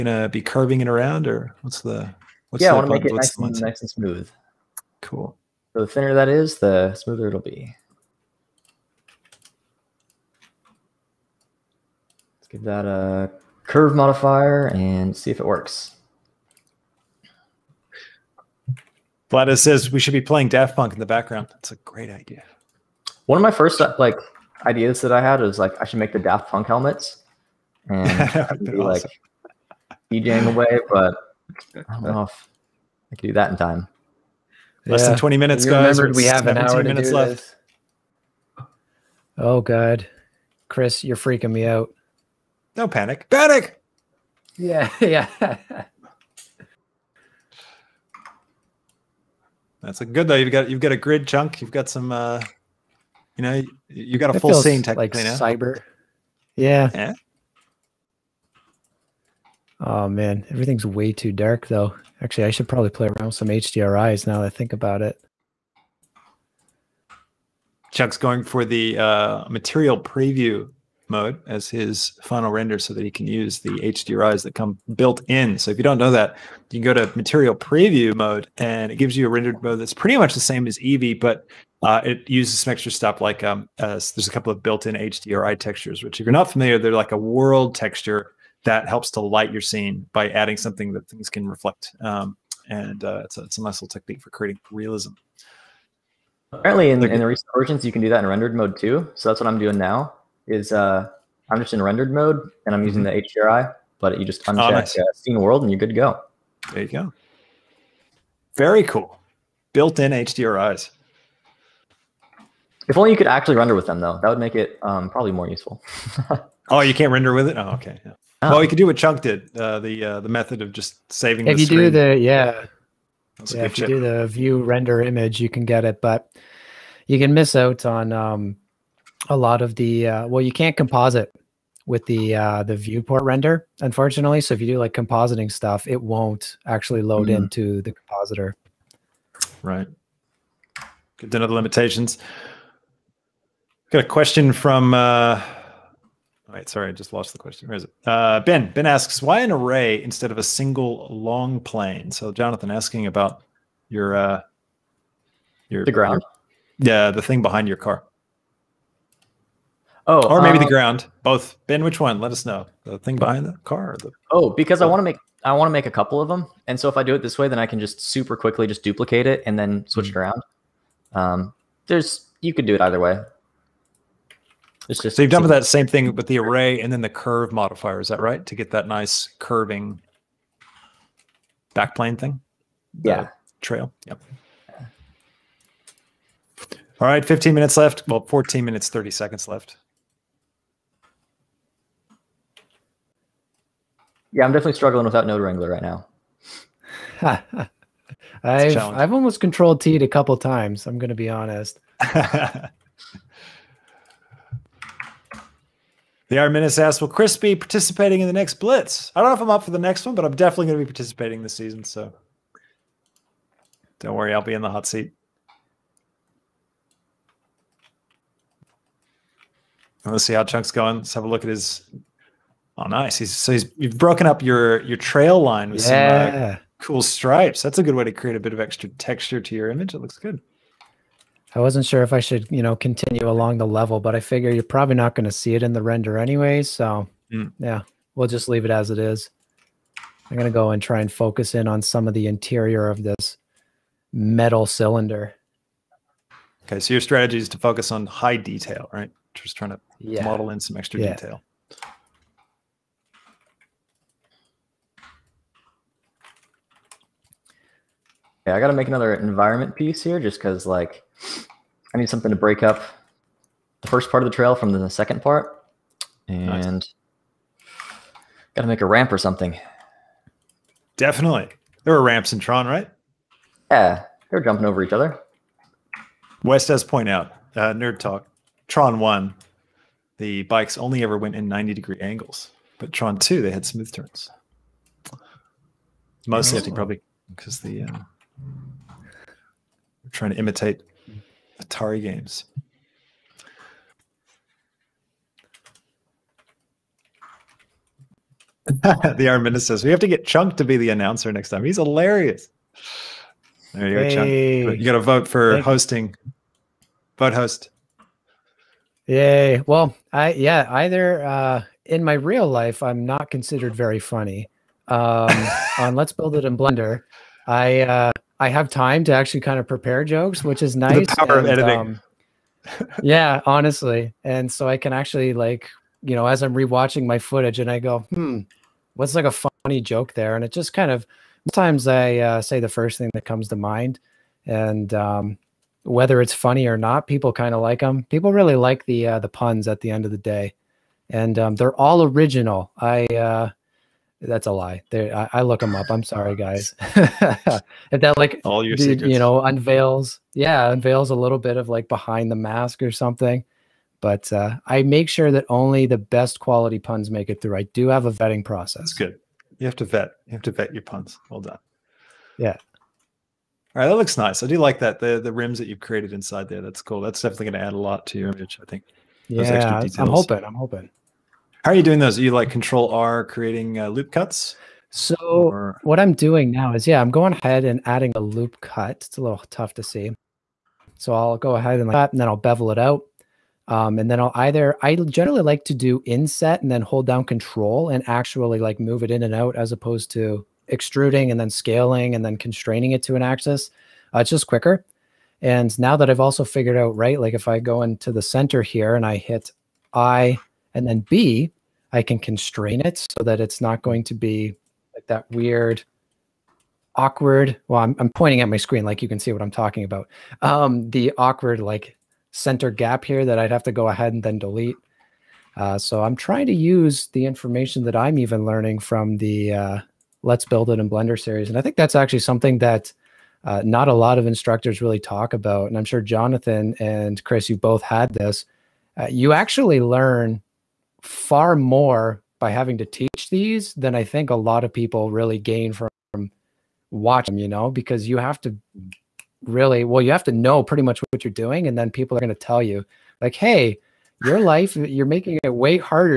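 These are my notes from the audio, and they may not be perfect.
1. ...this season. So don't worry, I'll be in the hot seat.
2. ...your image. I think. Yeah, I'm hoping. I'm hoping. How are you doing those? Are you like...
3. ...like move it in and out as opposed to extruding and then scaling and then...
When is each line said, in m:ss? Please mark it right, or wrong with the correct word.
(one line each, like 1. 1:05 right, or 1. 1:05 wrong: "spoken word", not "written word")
1. 3:31 right
2. 6:08 right
3. 6:28 right.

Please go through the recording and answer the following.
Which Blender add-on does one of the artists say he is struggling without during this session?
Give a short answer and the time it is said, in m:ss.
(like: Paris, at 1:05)
Node Wrangler, at 3:15.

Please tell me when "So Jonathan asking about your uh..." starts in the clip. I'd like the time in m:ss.
2:32.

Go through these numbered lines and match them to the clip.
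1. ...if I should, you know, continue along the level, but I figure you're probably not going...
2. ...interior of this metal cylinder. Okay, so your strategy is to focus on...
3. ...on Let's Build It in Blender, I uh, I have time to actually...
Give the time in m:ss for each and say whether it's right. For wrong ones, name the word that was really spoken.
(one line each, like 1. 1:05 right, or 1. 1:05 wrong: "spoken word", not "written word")
1. 3:52 right
2. 4:02 right
3. 5:15 right.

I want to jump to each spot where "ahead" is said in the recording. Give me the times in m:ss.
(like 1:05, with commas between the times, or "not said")
6:17, 6:21, 6:53.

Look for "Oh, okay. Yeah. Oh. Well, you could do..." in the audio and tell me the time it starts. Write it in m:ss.
1:57.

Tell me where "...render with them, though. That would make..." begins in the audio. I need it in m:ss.
1:53.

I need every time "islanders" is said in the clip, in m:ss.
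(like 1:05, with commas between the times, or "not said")
not said.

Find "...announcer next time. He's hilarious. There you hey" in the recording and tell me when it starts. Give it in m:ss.
5:00.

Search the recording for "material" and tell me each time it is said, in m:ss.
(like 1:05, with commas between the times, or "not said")
1:09, 1:17.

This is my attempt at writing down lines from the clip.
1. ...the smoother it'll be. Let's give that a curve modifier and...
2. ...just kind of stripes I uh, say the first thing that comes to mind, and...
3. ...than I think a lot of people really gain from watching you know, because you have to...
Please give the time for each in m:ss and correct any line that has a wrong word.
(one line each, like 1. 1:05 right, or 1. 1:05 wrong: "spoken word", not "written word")
1. 0:06 right
2. 5:30 wrong: "sometimes", not "stripes"
3. 7:13 right.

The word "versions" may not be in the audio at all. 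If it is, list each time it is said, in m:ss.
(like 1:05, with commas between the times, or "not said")
1:37.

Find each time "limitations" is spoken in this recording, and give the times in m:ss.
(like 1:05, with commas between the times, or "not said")
2:21.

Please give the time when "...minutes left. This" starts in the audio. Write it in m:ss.
0:36.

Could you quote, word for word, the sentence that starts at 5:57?
I do have a vetting process.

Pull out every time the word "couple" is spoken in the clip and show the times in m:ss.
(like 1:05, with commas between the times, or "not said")
1:24, 2:45, 3:20.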